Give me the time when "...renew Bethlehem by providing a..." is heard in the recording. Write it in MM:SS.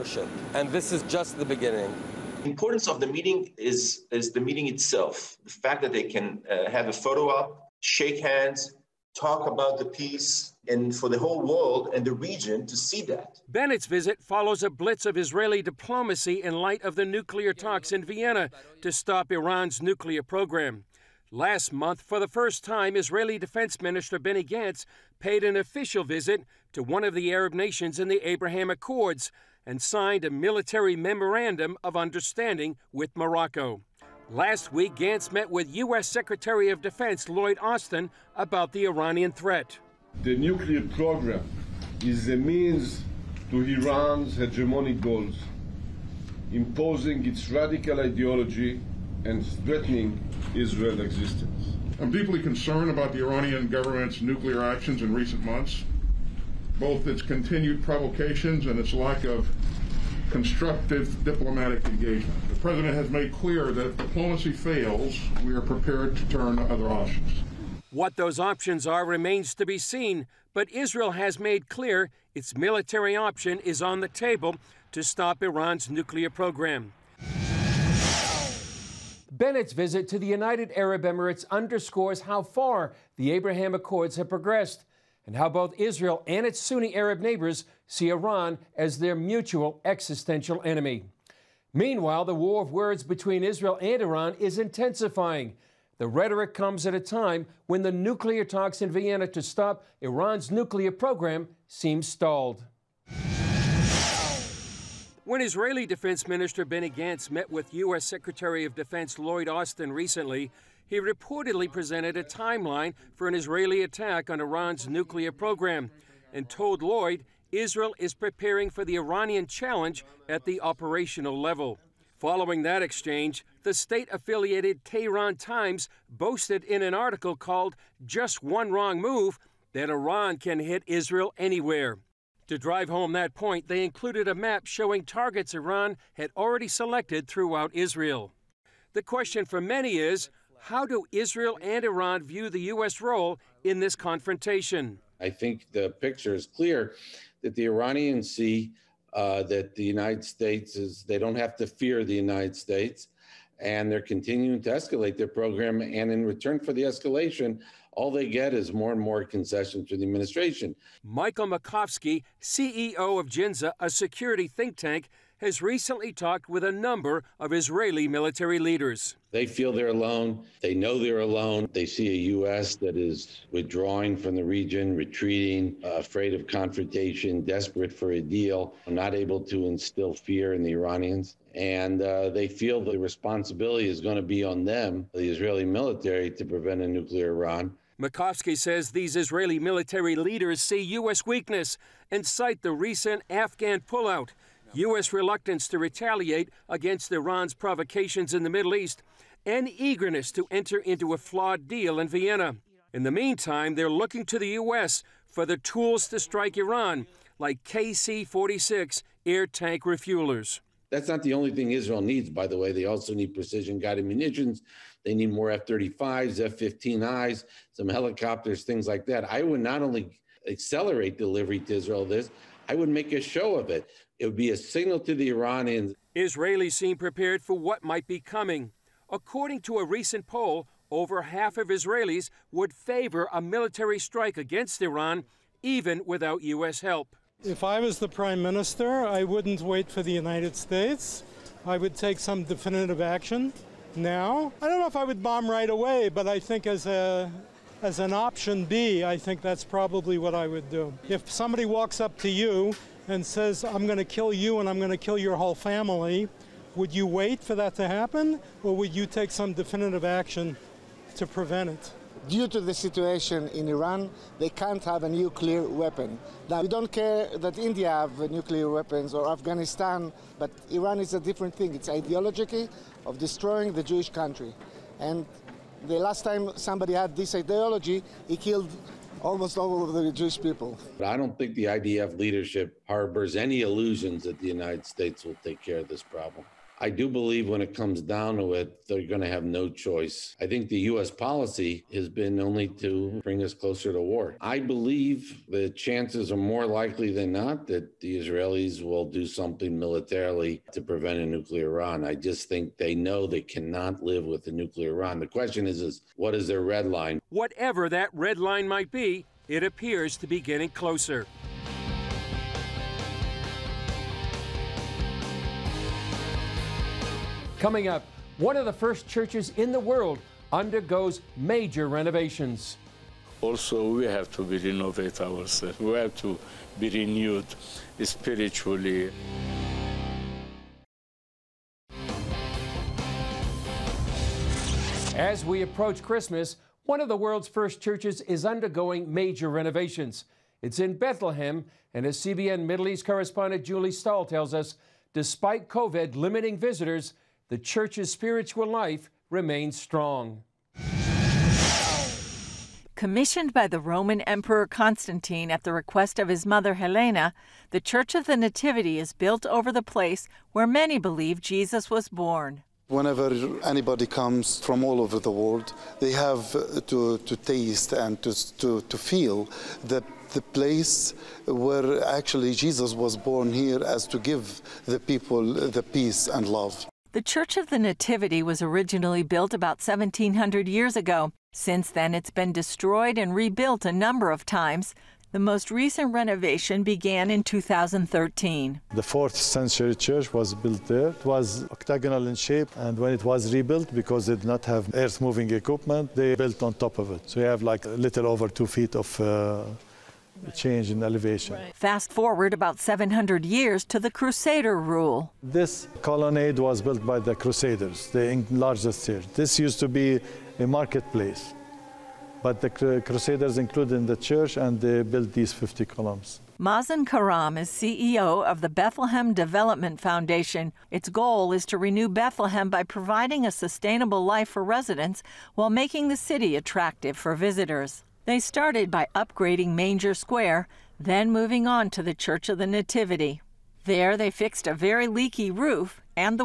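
07:01.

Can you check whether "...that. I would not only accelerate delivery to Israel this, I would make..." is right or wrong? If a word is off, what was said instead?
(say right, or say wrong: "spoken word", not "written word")
right.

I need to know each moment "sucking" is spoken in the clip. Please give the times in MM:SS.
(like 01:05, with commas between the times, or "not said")
not said.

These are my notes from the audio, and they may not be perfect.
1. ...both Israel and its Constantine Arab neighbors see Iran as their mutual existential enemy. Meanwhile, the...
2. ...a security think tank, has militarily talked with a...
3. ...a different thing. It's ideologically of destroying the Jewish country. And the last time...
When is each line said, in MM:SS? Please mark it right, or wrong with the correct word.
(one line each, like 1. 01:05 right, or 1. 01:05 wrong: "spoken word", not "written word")
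1. 01:25 wrong: "Sunni", not "Constantine"
2. 02:43 wrong: "recently", not "militarily"
3. 04:31 right.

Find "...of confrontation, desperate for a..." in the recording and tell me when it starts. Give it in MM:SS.
02:56.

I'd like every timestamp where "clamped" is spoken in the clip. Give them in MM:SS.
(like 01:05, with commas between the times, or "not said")
not said.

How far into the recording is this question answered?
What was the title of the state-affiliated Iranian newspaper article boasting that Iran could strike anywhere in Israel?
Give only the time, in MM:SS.
02:08.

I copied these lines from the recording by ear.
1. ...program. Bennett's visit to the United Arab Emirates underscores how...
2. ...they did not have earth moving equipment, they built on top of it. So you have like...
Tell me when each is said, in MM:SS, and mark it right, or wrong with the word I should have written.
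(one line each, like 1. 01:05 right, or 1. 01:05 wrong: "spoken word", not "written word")
1. 01:16 right
2. 06:34 right.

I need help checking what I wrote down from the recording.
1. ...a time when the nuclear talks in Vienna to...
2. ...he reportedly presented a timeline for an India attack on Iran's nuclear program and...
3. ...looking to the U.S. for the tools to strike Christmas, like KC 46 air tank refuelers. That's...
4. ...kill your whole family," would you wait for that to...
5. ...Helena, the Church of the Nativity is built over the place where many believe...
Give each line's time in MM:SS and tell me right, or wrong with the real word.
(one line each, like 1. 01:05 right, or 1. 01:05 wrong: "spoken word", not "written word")
1. 01:36 right
2. 01:50 wrong: "Israeli", not "India"
3. 03:23 wrong: "Iran", not "Christmas"
4. 04:15 right
5. 05:56 right.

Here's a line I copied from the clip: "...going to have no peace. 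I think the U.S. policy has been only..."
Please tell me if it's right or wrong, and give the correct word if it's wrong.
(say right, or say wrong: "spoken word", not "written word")
wrong: "choice", not "peace".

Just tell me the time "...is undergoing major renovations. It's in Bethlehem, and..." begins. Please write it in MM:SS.
05:38.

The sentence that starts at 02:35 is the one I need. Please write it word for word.
And in return for the escalation, all they get is more and more concessions to the administration.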